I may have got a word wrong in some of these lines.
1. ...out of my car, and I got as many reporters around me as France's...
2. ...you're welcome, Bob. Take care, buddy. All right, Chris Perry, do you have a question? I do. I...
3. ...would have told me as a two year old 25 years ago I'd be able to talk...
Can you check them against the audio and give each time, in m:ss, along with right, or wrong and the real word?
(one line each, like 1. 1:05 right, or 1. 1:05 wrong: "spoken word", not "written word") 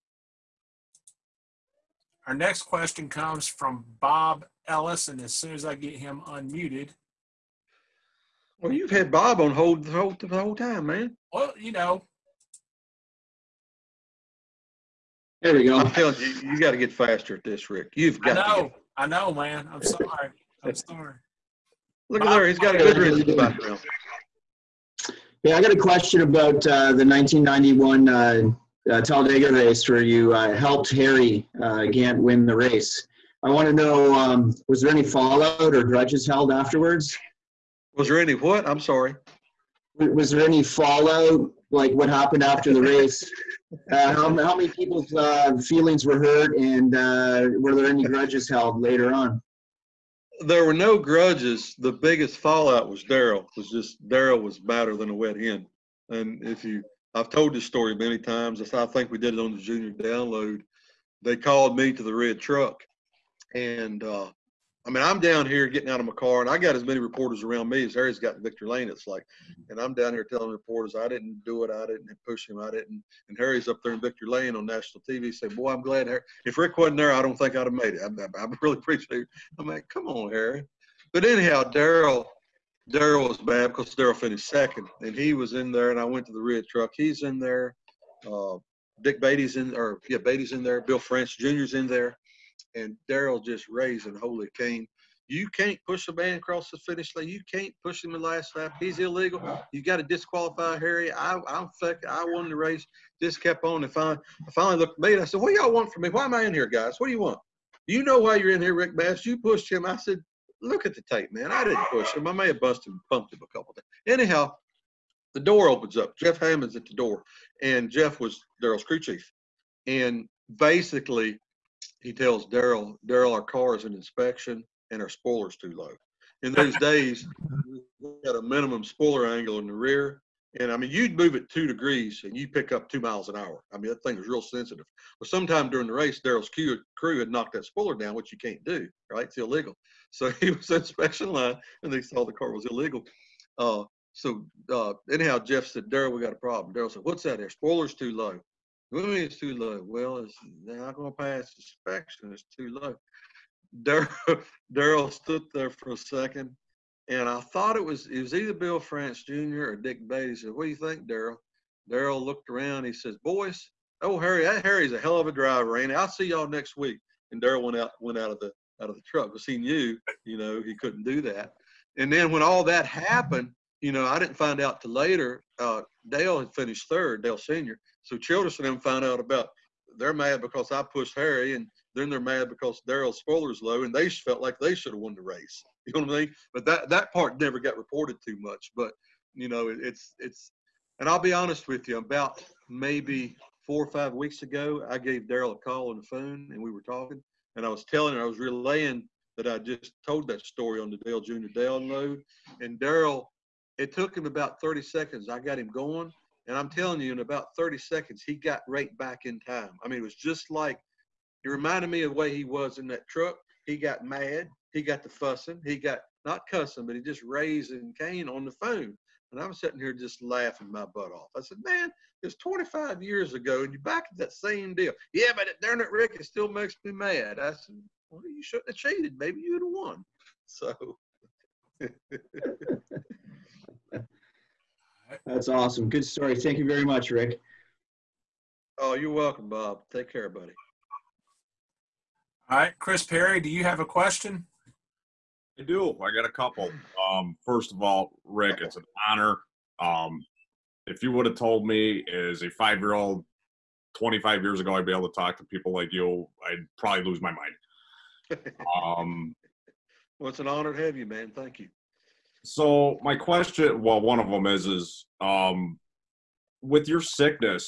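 1. 1:05 wrong: "Harry", not "France"
2. 3:58 right
3. 4:11 wrong: "five", not "two".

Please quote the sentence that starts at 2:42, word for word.
He says, "Boys, oh Harry, that Harry's a hell of a driver, ain't he?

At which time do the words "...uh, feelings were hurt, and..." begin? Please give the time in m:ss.
0:45.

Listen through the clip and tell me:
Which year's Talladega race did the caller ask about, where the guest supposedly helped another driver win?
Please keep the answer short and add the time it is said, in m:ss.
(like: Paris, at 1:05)
1991, at 0:27.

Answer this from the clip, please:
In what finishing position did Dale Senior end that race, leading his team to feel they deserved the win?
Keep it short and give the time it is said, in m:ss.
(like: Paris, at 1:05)
Third, at 2:56.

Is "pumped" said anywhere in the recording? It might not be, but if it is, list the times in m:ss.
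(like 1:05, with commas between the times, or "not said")
1:53.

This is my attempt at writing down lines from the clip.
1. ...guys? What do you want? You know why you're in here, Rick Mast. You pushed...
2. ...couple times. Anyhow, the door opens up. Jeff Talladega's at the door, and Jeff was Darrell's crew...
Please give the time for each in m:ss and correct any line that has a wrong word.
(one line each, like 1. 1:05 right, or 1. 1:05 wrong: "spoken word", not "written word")
1. 1:46 right
2. 1:53 wrong: "Hammond", not "Talladega".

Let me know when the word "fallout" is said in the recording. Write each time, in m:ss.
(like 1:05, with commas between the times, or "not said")
0:35, 0:40, 0:52.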